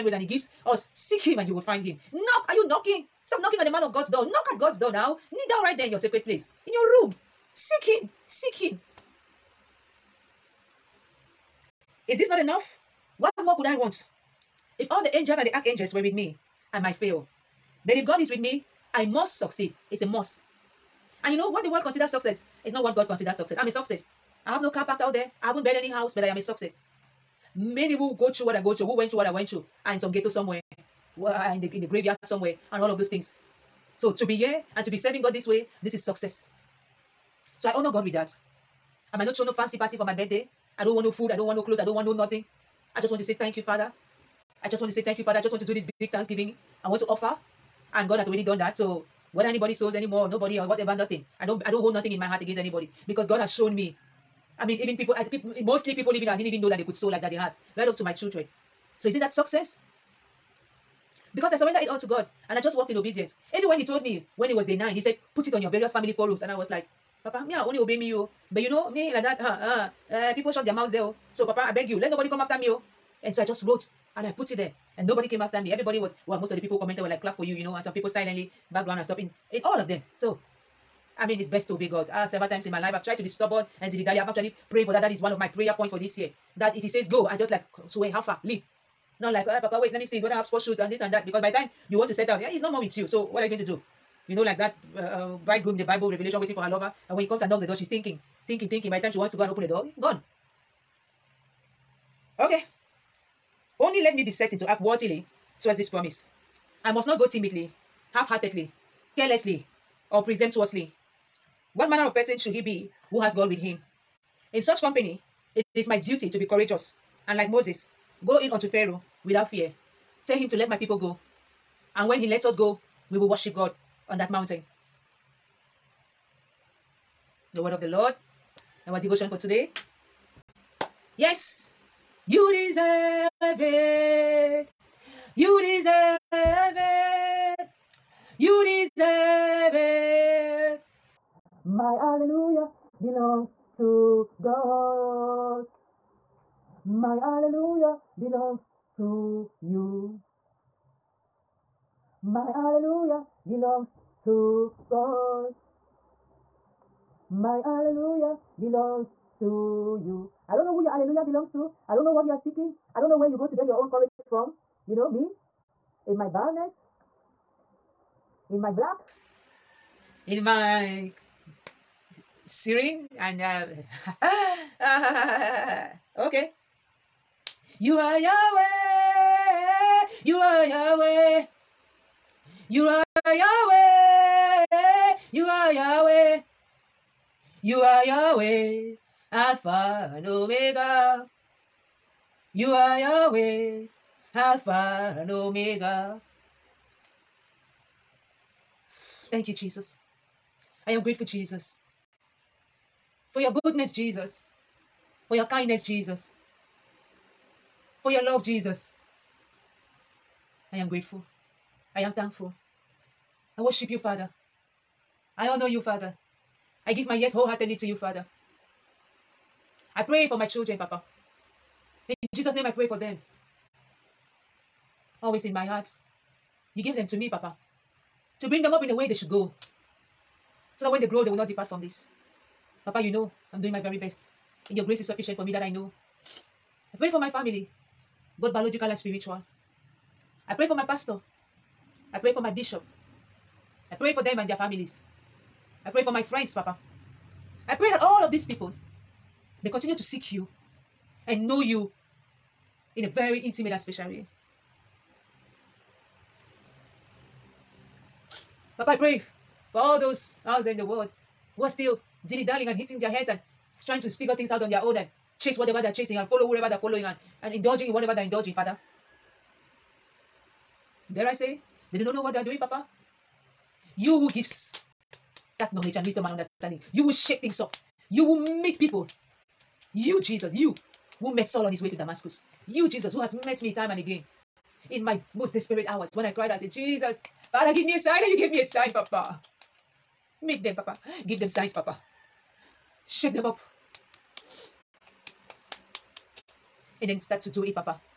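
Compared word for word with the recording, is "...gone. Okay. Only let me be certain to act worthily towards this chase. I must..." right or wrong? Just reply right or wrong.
wrong.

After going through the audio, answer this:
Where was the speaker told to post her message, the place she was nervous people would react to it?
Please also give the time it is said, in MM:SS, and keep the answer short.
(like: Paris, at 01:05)
Family forums, at 01:05.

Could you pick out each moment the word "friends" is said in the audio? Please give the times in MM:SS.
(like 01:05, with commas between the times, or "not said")
04:06.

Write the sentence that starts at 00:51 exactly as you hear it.
I don't I don't hold nothing in my heart against anybody because God has shown me.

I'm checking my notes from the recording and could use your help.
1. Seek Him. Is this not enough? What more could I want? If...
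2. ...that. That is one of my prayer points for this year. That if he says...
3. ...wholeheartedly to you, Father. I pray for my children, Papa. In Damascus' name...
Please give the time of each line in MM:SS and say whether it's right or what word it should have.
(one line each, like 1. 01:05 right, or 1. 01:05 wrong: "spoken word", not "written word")
1. 00:08 right
2. 01:24 right
3. 03:37 wrong: "Jesus", not "Damascus".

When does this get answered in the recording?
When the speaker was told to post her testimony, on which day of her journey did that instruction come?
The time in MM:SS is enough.
01:04.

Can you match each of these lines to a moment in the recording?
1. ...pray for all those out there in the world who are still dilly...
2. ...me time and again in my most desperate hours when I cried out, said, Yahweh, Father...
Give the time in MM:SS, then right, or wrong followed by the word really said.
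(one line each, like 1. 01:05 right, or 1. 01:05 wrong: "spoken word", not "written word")
1. 04:18 right
2. 04:43 wrong: "Jesus", not "Yahweh".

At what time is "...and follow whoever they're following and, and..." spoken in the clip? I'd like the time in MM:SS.
04:26.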